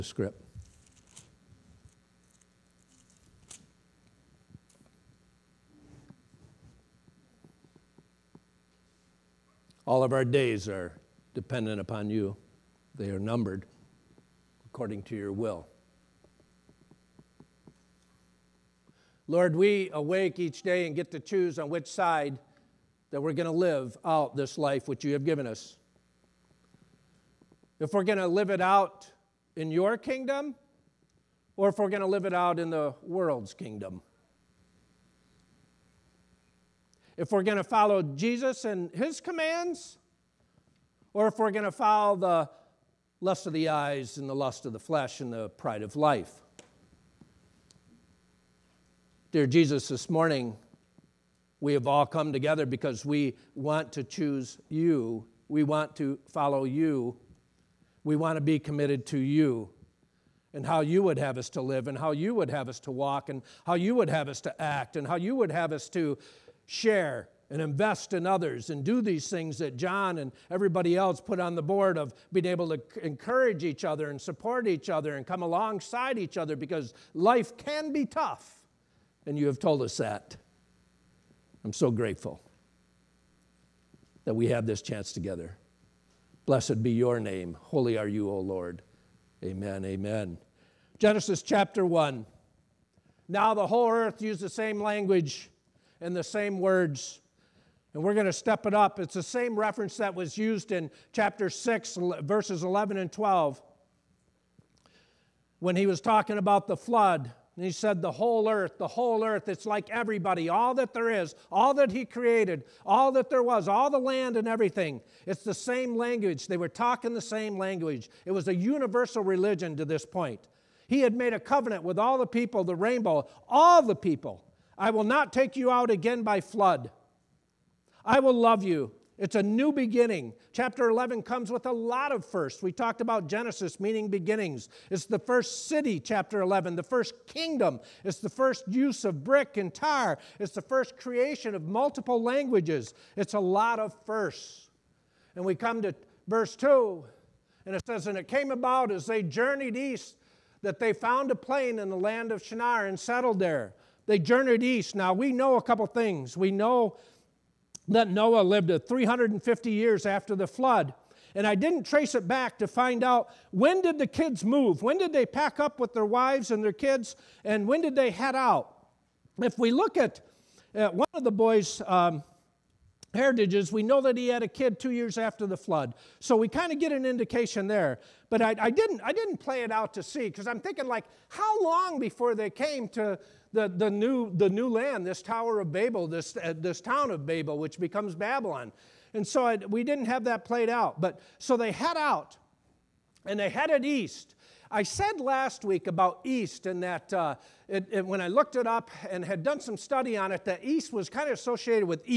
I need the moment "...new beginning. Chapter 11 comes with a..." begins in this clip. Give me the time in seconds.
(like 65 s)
129 s.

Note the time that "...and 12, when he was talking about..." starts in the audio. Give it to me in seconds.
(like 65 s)
102 s.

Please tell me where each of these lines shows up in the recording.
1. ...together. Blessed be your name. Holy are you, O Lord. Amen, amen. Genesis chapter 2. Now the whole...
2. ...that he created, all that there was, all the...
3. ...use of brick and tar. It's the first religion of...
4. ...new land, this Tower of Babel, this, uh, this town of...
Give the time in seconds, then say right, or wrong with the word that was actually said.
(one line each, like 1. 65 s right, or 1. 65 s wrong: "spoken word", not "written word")
1. 85 s wrong: "1", not "2"
2. 111 s right
3. 138 s wrong: "creation", not "religion"
4. 184 s right.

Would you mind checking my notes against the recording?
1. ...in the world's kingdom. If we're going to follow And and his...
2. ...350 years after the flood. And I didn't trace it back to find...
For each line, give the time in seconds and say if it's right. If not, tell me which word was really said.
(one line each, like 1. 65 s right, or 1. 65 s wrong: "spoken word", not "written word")
1. 32 s wrong: "Jesus", not "And"
2. 158 s right.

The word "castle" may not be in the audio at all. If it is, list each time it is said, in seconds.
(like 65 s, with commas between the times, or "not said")
not said.